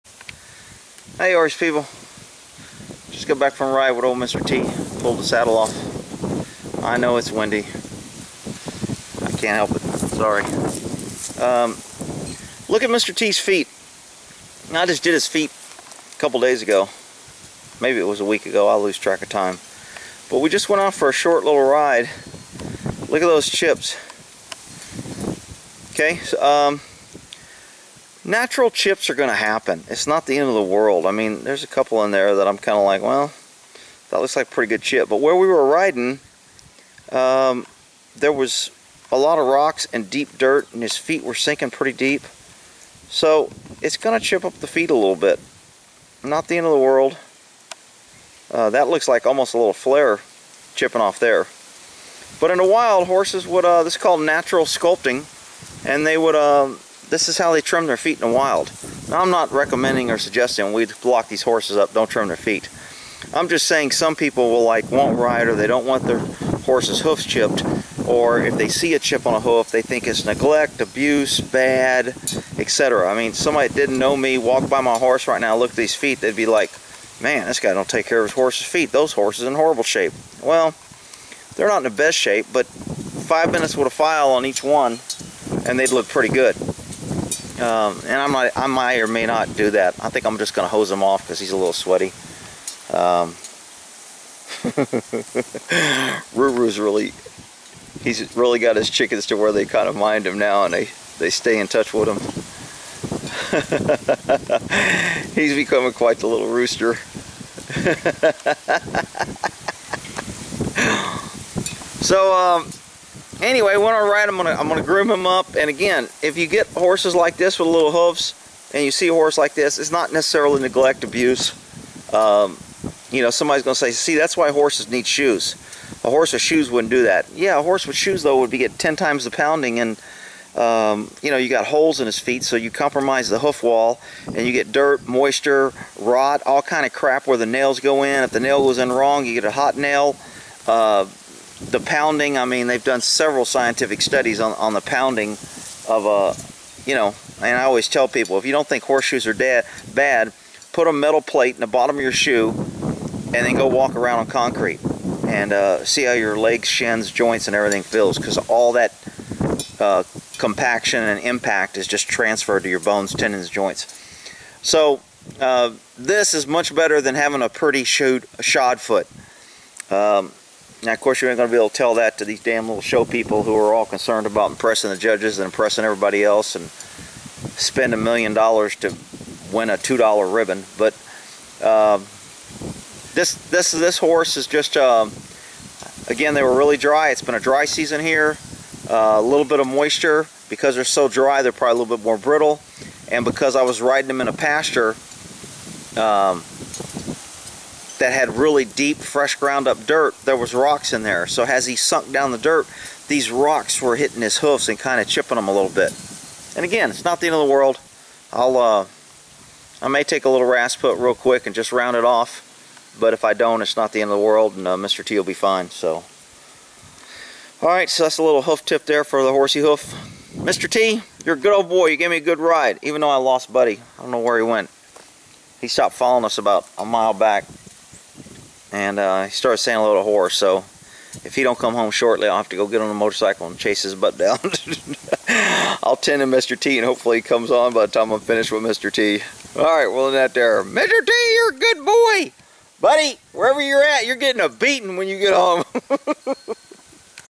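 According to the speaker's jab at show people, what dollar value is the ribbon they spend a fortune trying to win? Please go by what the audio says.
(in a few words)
$2.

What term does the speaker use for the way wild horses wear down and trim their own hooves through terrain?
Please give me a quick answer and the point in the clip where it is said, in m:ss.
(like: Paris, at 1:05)
natural sculpting, at 0:54.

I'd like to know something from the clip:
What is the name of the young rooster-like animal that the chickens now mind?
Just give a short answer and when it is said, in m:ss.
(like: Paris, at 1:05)
Ruru, at 1:36.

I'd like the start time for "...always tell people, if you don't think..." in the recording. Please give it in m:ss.
2:27.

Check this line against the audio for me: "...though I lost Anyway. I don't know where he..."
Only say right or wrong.
wrong.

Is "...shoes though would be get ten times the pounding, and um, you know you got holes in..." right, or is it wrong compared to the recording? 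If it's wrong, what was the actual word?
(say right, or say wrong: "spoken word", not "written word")
right.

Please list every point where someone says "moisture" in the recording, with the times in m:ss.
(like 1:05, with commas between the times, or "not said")
2:15, 3:09.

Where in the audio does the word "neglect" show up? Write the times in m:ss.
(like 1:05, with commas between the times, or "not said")
1:10, 2:00.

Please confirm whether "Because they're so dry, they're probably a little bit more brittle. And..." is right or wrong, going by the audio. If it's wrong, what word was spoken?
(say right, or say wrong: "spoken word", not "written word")
right.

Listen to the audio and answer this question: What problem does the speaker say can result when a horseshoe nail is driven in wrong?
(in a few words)
a hot nail.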